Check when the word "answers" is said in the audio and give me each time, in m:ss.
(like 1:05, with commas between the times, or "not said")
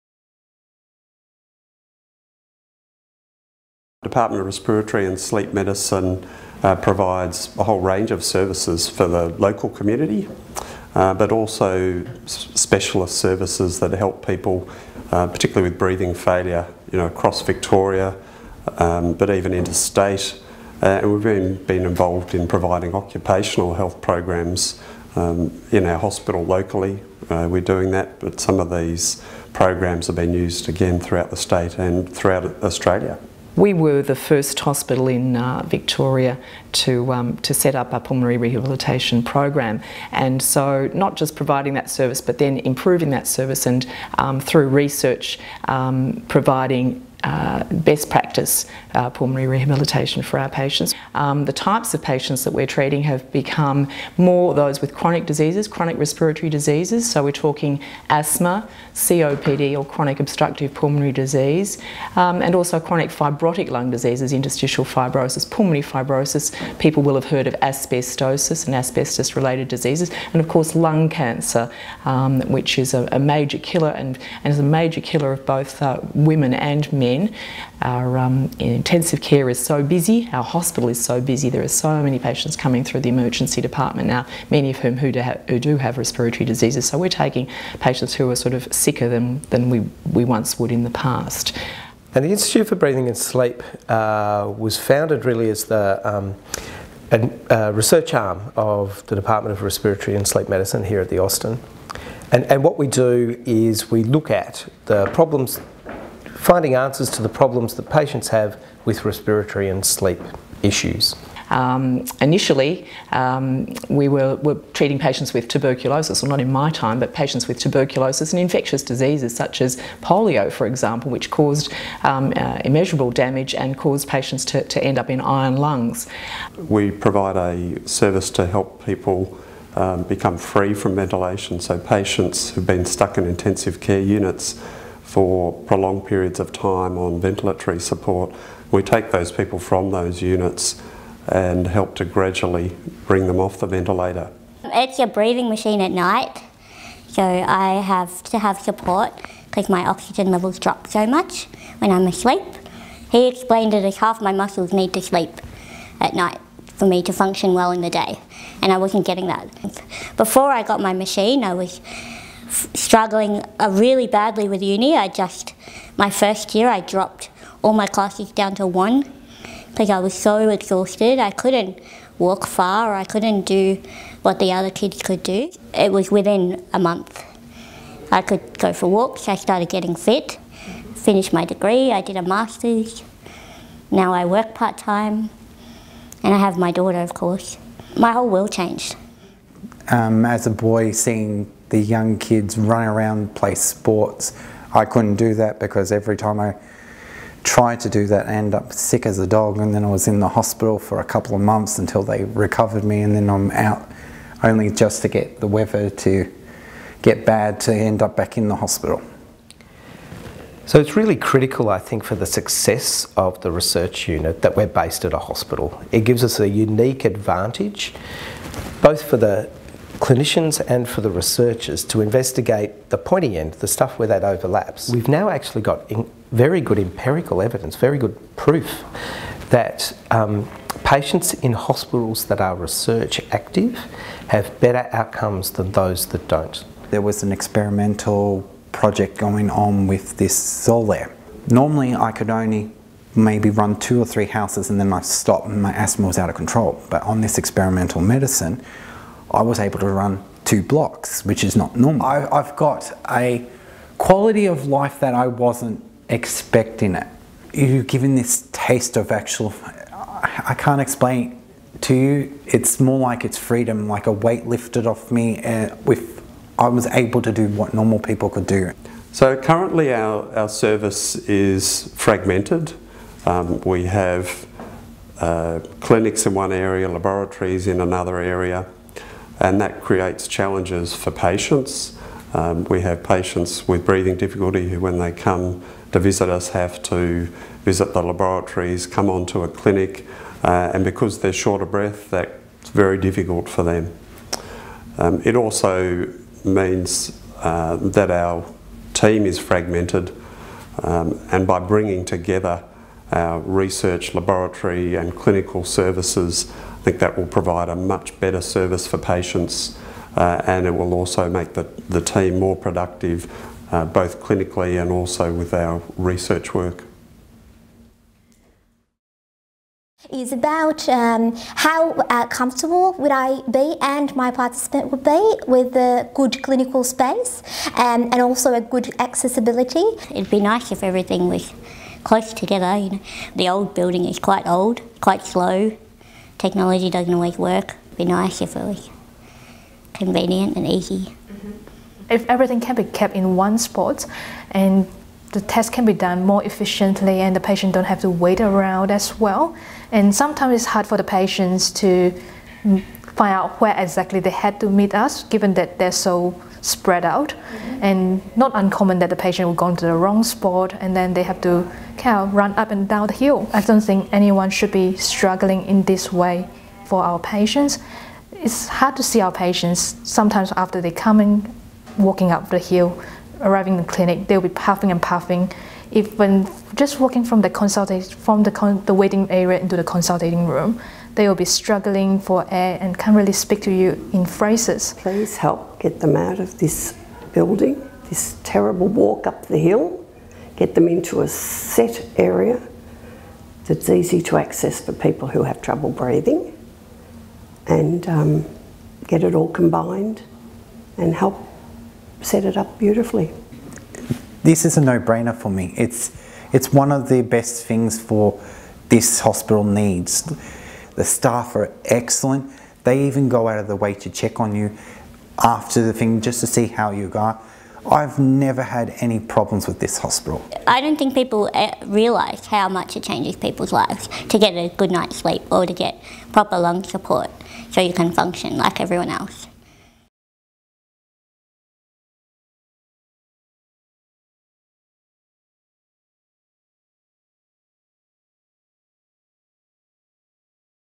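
1:46.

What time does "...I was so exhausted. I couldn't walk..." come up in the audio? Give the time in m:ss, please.
2:49.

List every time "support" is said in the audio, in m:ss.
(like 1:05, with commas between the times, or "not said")
2:17, 2:28, 7:06.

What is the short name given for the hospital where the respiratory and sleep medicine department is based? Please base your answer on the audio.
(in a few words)
The Austin.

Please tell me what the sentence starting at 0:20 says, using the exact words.
Uh, and we've been, been involved in providing occupational health programs um, in our hospital locally.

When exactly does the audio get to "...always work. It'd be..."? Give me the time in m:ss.
5:37.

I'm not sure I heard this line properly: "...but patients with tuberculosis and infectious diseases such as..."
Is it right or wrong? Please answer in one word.
right.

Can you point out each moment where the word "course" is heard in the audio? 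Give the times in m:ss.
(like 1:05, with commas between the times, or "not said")
1:10, 3:07.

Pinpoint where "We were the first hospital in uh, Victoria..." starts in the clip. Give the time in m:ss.
0:33.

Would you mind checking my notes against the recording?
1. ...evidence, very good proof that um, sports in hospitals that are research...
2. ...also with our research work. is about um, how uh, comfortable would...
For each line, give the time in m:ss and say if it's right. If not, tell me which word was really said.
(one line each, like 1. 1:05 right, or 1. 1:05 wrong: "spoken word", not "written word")
1. 3:47 wrong: "patients", not "sports"
2. 5:14 right.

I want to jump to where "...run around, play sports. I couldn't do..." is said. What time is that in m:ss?
3:12.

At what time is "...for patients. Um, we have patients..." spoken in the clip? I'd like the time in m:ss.
4:40.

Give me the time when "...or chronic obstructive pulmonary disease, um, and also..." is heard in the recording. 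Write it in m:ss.
0:59.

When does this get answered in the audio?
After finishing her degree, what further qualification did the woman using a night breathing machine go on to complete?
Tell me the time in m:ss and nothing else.
3:02.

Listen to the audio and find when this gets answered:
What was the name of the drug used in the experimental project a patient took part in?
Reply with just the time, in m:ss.
4:00.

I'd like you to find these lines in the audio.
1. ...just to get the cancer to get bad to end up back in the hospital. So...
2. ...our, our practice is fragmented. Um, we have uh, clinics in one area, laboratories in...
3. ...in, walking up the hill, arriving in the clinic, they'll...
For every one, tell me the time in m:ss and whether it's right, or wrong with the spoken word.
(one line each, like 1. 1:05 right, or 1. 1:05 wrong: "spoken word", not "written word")
1. 3:24 wrong: "weather", not "cancer"
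2. 4:29 wrong: "service", not "practice"
3. 6:11 right.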